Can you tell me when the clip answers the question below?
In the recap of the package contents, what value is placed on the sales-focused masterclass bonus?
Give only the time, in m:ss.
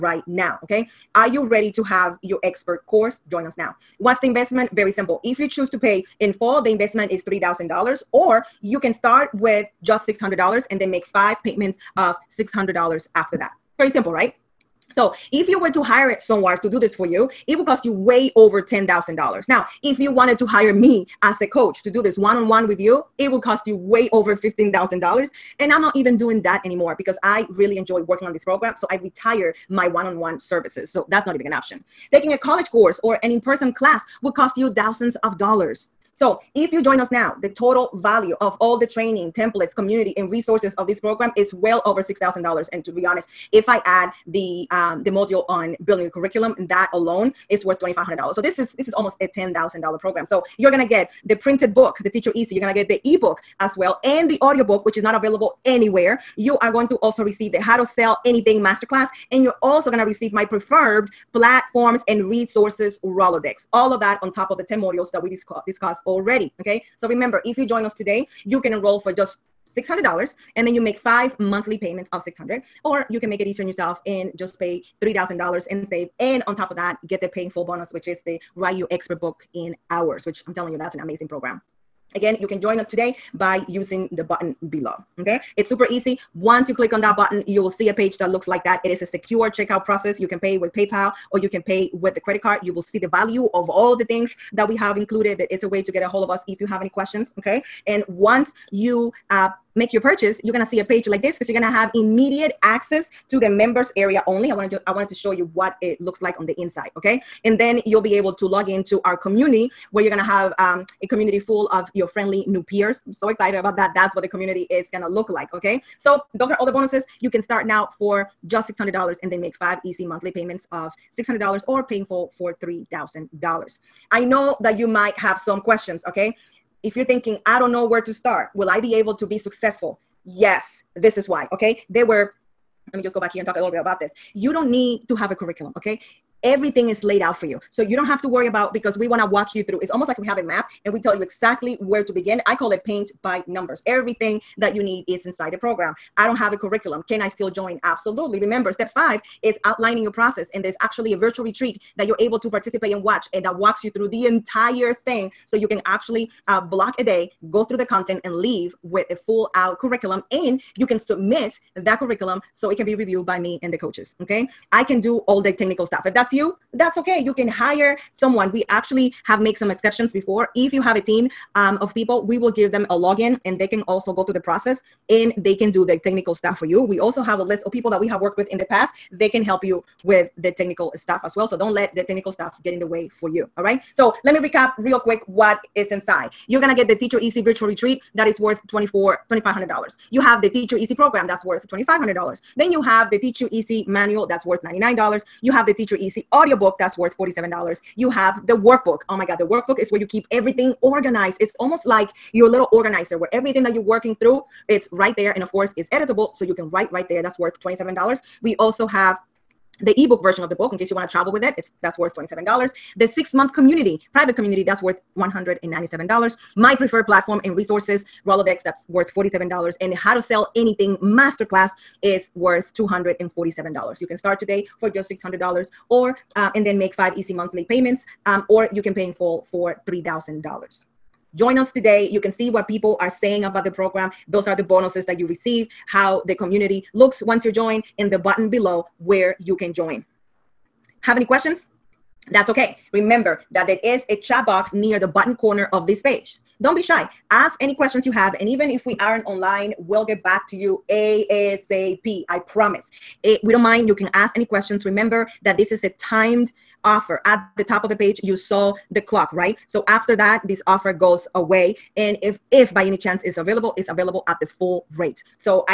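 3:42.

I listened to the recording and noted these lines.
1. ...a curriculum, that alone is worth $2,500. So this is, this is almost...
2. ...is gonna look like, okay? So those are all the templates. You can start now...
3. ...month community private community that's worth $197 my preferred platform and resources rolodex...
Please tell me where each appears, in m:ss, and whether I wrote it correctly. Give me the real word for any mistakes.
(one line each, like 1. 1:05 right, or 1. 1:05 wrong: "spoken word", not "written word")
1. 0:46 right
2. 1:54 wrong: "bonuses", not "templates"
3. 3:33 right.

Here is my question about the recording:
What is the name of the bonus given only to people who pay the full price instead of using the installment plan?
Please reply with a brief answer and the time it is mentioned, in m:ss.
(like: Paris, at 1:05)
Write Your Expert Book in hours, at 1:18.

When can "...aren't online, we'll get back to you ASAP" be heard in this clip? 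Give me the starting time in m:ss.
4:08.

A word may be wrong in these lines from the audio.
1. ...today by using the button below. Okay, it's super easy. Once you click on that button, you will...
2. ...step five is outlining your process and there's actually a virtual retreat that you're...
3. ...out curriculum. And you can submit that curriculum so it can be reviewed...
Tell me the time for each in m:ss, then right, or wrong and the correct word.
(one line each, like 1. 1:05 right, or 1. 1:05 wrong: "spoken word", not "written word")
1. 1:22 right
2. 2:28 right
3. 2:39 right.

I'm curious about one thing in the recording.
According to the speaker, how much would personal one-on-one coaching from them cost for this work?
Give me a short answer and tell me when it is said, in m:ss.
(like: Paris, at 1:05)
over $15,000, at 0:23.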